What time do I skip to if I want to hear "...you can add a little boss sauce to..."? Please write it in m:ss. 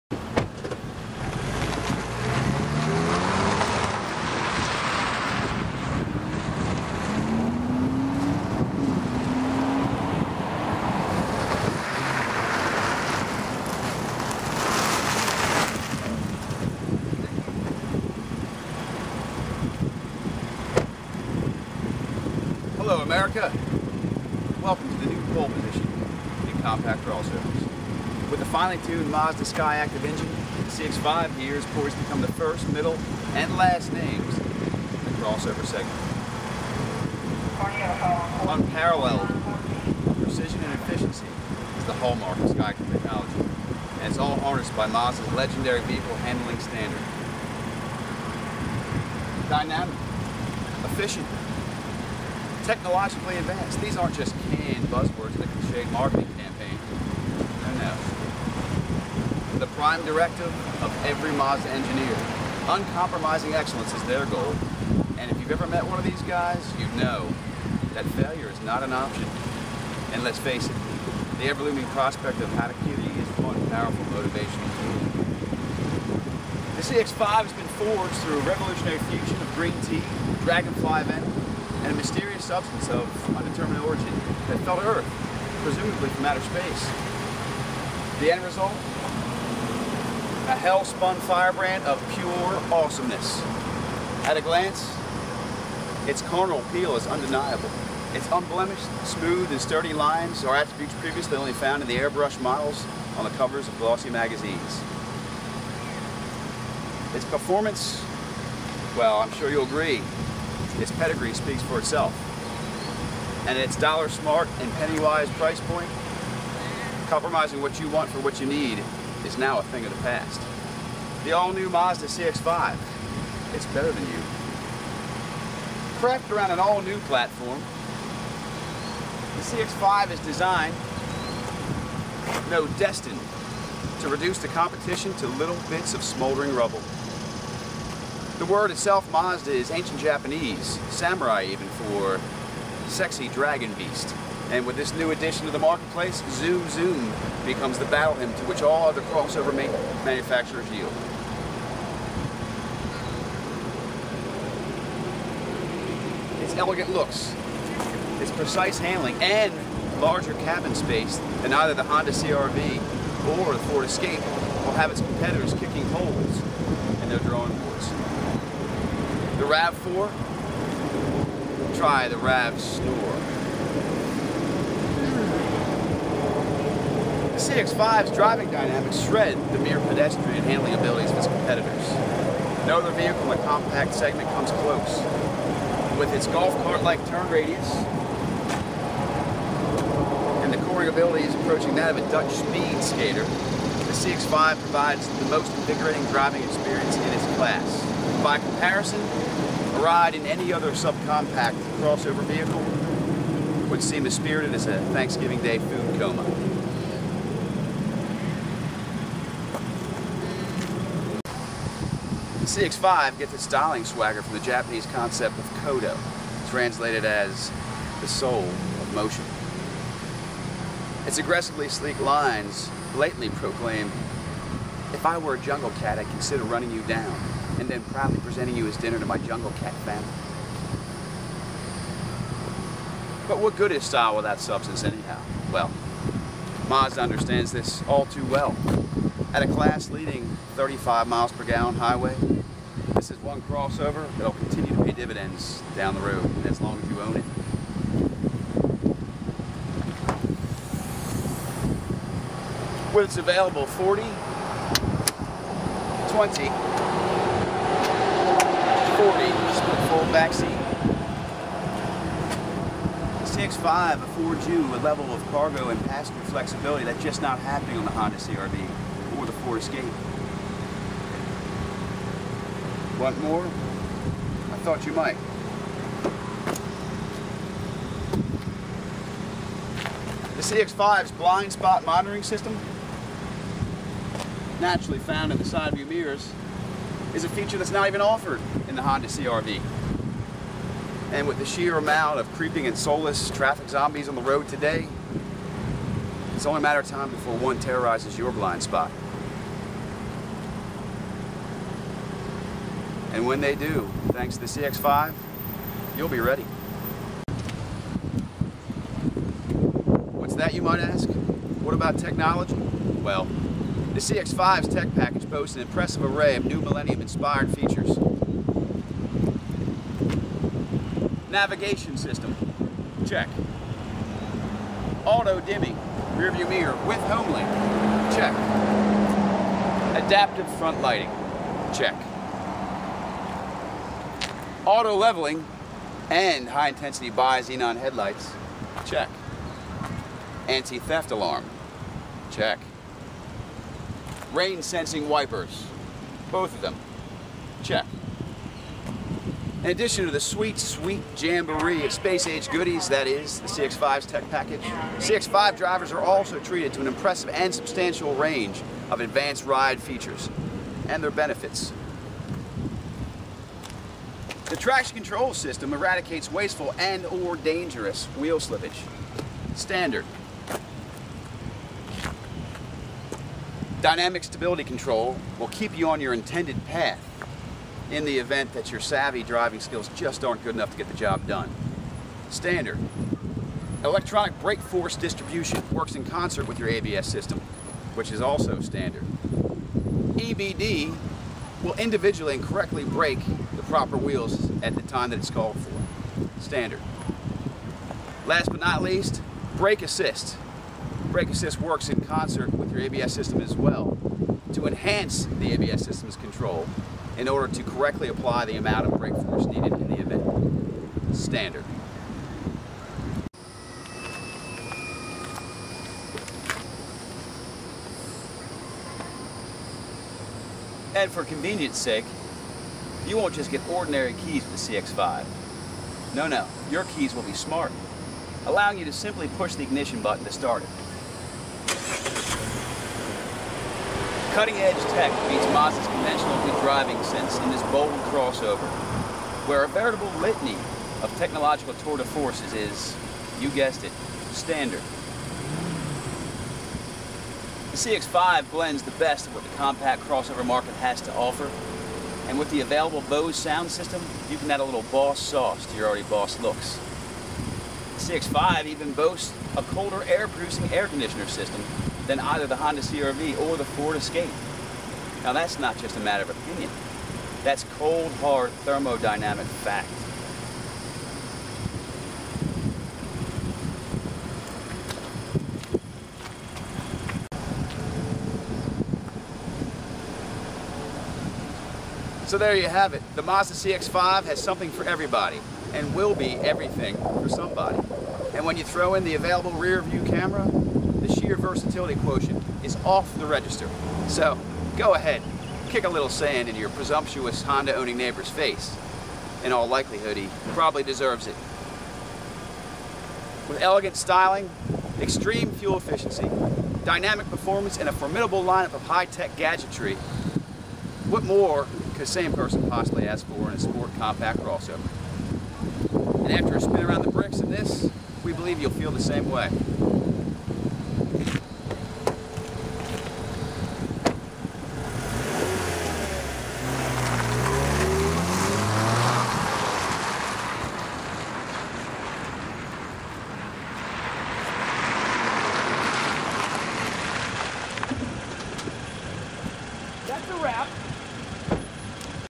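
7:34.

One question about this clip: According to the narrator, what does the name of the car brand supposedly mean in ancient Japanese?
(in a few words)
Sexy dragon beast.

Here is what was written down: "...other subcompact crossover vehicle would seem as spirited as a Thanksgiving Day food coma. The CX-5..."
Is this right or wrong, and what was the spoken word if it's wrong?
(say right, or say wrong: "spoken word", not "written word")
right.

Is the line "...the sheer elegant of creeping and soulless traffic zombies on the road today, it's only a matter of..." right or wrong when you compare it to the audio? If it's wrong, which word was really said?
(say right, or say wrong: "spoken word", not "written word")
wrong: "amount", not "elegant".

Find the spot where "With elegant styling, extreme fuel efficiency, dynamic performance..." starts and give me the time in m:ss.
8:23.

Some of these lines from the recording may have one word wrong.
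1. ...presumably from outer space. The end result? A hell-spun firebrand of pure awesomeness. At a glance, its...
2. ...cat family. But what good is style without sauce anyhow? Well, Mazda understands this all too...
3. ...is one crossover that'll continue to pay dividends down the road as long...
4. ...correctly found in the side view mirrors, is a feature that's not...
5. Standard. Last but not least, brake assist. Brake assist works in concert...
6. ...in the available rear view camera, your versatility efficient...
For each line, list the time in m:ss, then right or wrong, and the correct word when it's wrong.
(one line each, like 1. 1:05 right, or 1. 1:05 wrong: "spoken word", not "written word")
1. 1:25 right
2. 3:49 wrong: "substance", not "sauce"
3. 4:03 right
4. 4:44 wrong: "naturally", not "correctly"
5. 6:36 right
6. 8:08 wrong: "quotient", not "efficient".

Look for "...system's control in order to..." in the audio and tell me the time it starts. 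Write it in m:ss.
6:45.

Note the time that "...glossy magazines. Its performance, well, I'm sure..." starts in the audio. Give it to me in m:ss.
1:43.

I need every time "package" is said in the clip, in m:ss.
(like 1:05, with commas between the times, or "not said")
5:14, 5:54.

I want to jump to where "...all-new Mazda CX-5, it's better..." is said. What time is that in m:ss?
2:01.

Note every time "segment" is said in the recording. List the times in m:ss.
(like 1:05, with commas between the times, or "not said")
0:35, 3:03.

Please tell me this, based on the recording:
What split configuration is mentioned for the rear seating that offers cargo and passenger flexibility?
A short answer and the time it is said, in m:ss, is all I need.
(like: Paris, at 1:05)
40/20/40, at 4:13.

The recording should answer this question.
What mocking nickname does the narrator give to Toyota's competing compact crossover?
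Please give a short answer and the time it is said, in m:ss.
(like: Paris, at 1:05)
RAV Snore, at 2:52.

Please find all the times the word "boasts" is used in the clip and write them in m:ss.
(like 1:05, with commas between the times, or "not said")
5:15, 7:38.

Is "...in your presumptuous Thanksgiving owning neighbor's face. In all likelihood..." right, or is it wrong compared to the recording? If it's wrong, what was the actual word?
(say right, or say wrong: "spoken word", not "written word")
wrong: "Honda", not "Thanksgiving".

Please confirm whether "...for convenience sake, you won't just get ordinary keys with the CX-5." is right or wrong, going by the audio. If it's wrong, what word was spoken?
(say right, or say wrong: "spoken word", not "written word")
right.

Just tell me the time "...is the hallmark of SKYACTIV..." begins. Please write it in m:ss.
0:41.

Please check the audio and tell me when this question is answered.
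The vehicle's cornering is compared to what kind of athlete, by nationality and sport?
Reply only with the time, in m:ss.
3:12.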